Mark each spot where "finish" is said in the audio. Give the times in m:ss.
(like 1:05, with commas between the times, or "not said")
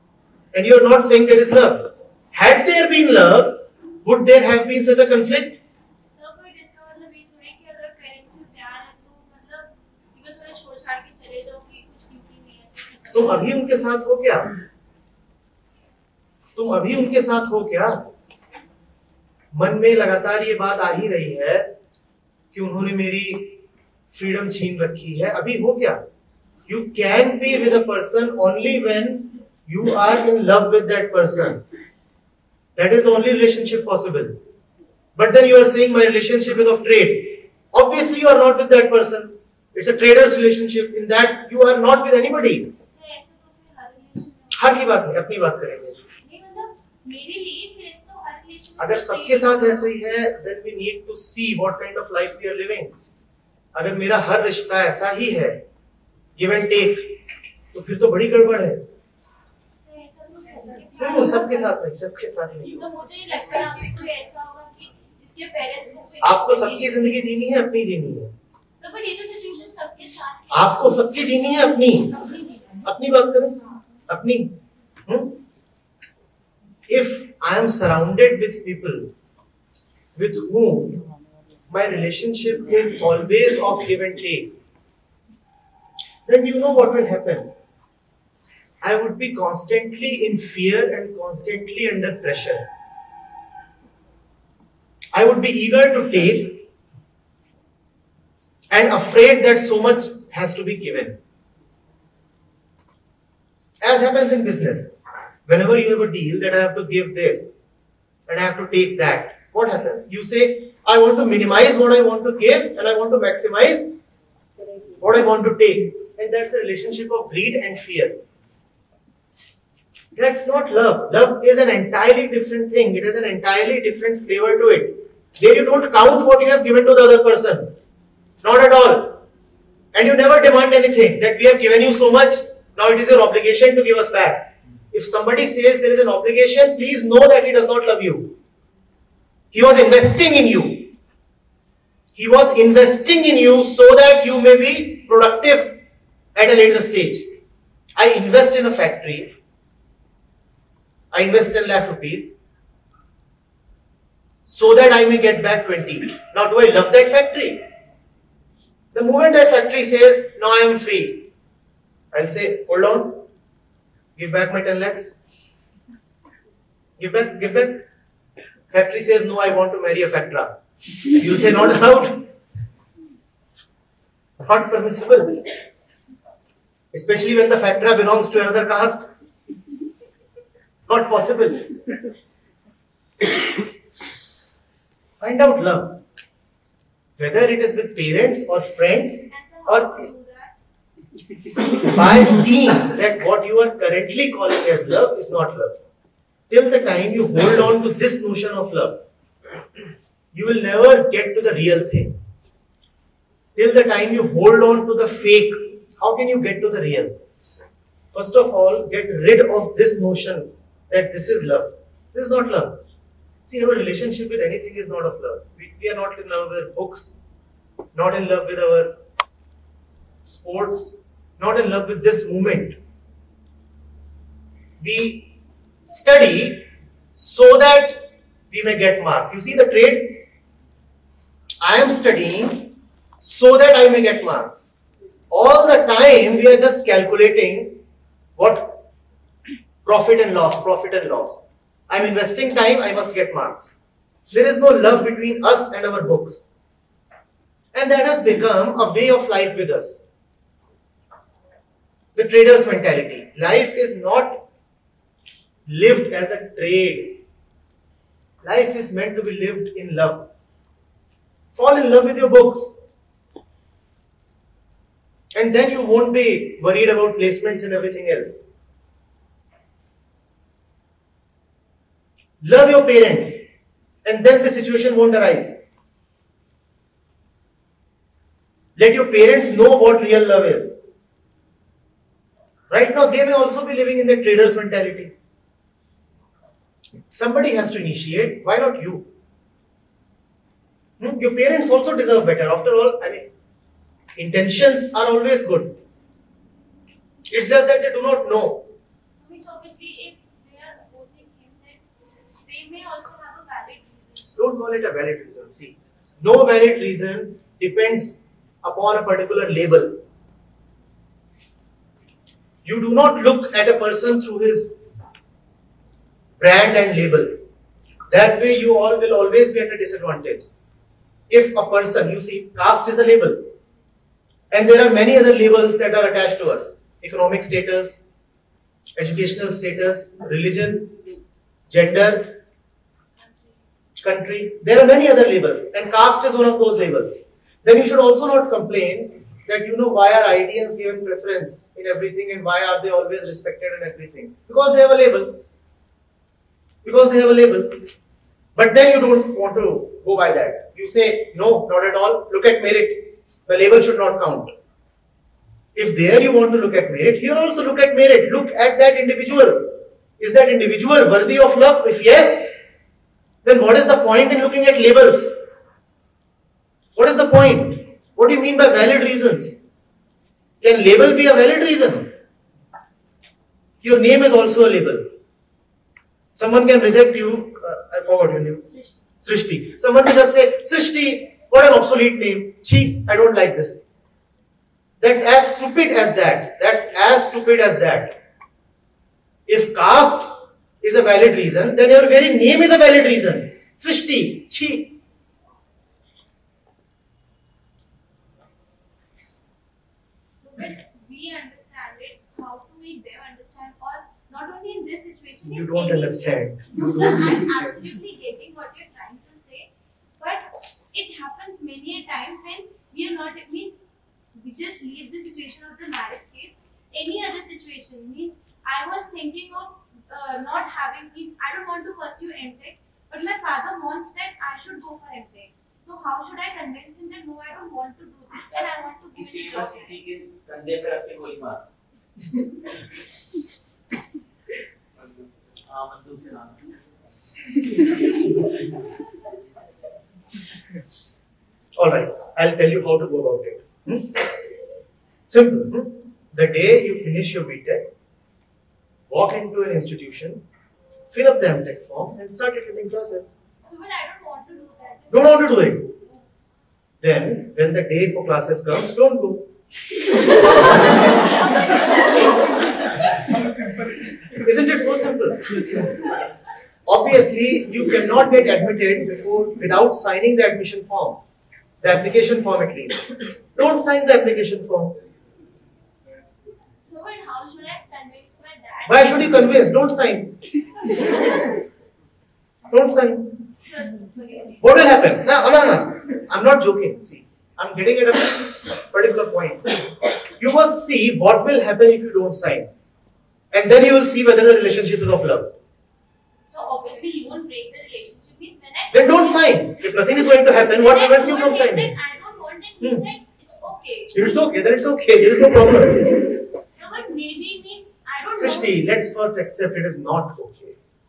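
7:27.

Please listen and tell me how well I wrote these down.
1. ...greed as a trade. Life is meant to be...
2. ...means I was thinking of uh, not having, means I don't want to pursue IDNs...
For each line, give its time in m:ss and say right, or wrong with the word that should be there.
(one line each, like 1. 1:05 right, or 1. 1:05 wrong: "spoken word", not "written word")
1. 4:15 wrong: "lived", not "greed"
2. 6:58 wrong: "MTech", not "IDNs".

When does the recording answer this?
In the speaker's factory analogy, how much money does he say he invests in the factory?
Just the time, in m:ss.
2:31.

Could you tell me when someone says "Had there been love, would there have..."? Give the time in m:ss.
0:02.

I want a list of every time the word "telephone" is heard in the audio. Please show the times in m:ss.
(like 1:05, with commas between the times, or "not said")
not said.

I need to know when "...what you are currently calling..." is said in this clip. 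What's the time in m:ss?
3:13.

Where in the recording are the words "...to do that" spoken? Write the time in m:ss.
7:34.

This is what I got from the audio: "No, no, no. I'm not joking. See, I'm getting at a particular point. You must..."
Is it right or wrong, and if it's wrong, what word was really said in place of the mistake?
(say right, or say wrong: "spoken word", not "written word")
right.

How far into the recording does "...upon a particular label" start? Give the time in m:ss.
5:08.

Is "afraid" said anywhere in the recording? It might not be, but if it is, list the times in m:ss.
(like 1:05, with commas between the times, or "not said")
1:38.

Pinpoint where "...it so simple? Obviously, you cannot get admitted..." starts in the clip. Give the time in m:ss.
7:44.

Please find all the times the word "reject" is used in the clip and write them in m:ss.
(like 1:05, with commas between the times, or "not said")
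6:16.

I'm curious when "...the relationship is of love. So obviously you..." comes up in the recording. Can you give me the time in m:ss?
8:14.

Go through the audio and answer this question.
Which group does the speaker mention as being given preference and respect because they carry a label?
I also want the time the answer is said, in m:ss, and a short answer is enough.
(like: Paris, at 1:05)
IDNs, at 5:40.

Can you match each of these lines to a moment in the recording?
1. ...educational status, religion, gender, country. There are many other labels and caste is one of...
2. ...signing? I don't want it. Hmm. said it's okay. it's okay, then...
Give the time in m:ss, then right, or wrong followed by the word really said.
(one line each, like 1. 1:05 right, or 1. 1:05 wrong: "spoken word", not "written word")
1. 5:28 right
2. 8:21 right.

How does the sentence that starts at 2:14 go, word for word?
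If somebody says there is an obligation, please know that he does not love you.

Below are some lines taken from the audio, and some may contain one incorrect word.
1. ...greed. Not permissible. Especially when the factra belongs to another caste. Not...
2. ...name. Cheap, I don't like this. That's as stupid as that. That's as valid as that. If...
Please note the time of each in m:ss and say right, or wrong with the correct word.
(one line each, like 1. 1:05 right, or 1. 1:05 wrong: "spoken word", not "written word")
1. 2:51 wrong: "allowed", not "greed"
2. 6:22 wrong: "stupid", not "valid".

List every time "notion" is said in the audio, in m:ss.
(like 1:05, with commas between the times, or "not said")
3:18, 3:29.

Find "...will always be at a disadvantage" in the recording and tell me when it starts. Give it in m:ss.
5:18.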